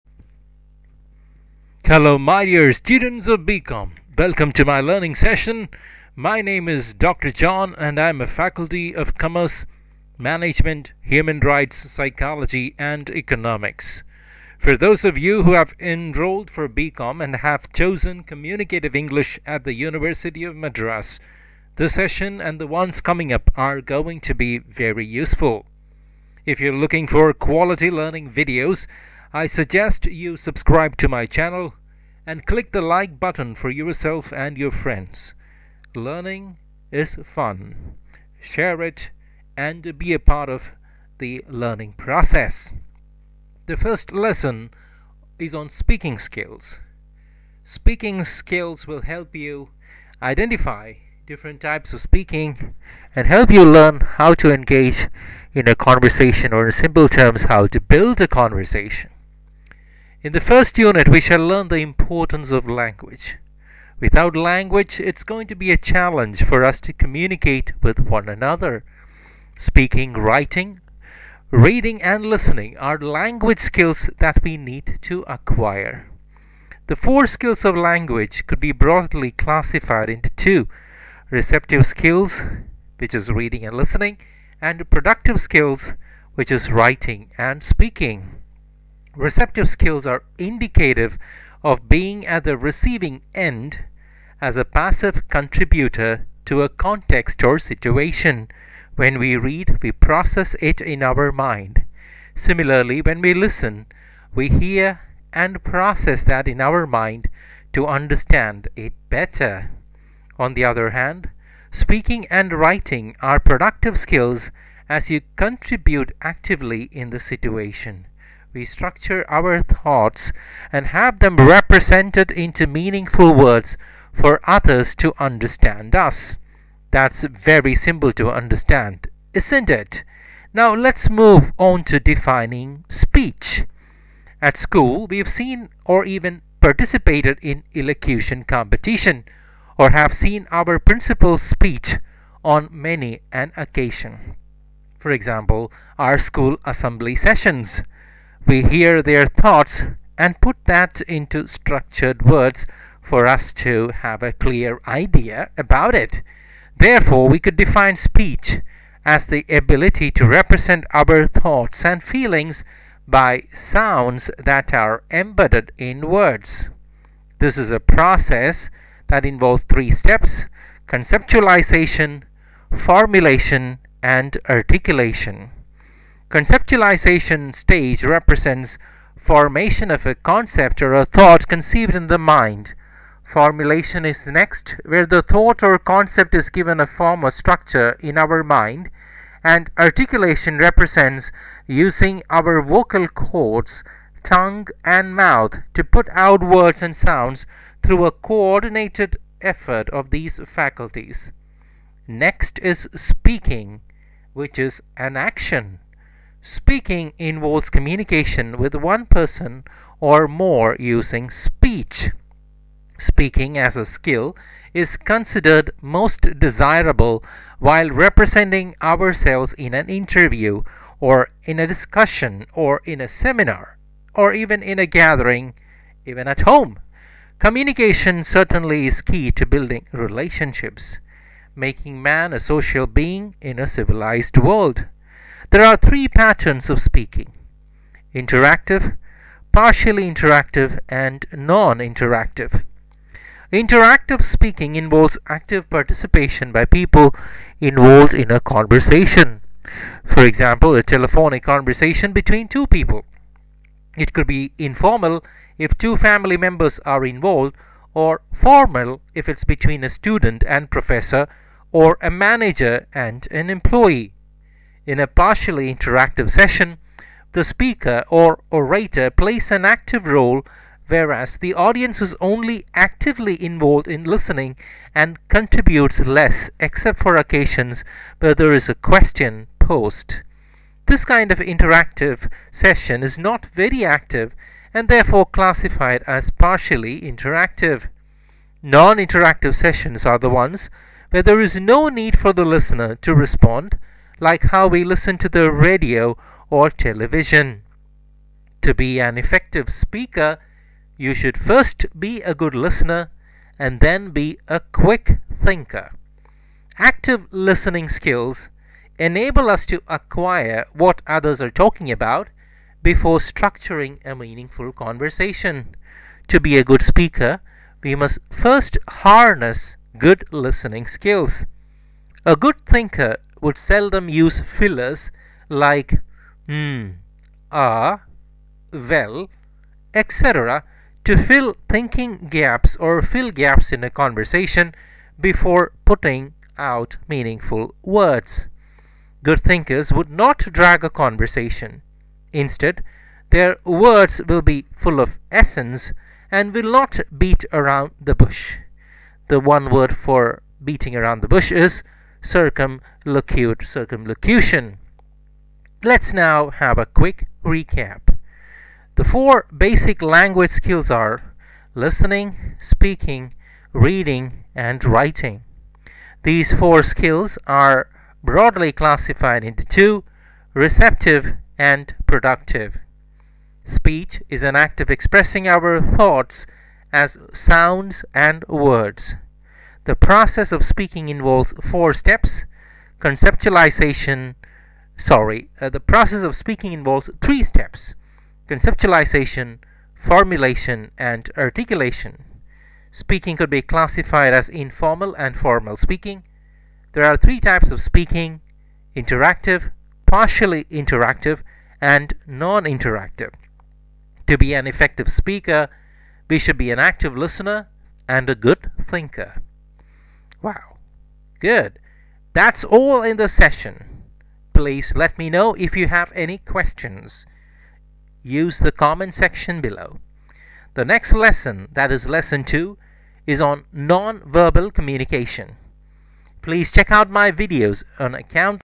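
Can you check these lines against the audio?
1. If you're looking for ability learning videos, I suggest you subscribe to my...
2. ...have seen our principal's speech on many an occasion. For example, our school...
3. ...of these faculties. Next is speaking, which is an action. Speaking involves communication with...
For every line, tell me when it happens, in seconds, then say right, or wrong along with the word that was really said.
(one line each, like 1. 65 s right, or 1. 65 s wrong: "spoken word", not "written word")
1. 26 s wrong: "quality", not "ability"
2. 139 s right
3. 199 s right.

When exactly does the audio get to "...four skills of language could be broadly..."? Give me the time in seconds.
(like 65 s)
76 s.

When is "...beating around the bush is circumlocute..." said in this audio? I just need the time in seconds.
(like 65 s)
350 s.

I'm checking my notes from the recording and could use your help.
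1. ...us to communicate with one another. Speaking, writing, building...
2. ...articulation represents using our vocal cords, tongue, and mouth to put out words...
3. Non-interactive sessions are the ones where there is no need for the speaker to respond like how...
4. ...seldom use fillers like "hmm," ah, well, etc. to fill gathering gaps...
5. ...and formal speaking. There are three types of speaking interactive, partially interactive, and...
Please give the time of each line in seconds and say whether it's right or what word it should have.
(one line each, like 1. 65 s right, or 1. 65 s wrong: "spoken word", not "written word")
1. 66 s wrong: "reading", not "building"
2. 189 s right
3. 288 s wrong: "listener", not "speaker"
4. 323 s wrong: "thinking", not "gathering"
5. 395 s right.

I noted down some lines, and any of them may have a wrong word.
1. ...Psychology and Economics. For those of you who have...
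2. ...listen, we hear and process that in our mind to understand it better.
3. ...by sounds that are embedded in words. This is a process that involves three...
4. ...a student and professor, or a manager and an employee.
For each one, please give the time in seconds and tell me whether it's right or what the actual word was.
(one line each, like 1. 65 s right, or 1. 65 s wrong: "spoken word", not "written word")
1. 11 s right
2. 103 s right
3. 163 s right
4. 259 s right.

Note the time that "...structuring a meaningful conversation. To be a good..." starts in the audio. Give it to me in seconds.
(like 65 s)
313 s.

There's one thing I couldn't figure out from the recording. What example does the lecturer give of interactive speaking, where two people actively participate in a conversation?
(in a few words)
Telephonic conversation.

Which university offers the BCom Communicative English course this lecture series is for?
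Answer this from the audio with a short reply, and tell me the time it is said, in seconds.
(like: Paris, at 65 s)
University of Madras, at 19 s.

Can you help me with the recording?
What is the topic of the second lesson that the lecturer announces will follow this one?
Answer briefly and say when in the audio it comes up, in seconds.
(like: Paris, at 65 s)
Non-verbal communication, at 423 s.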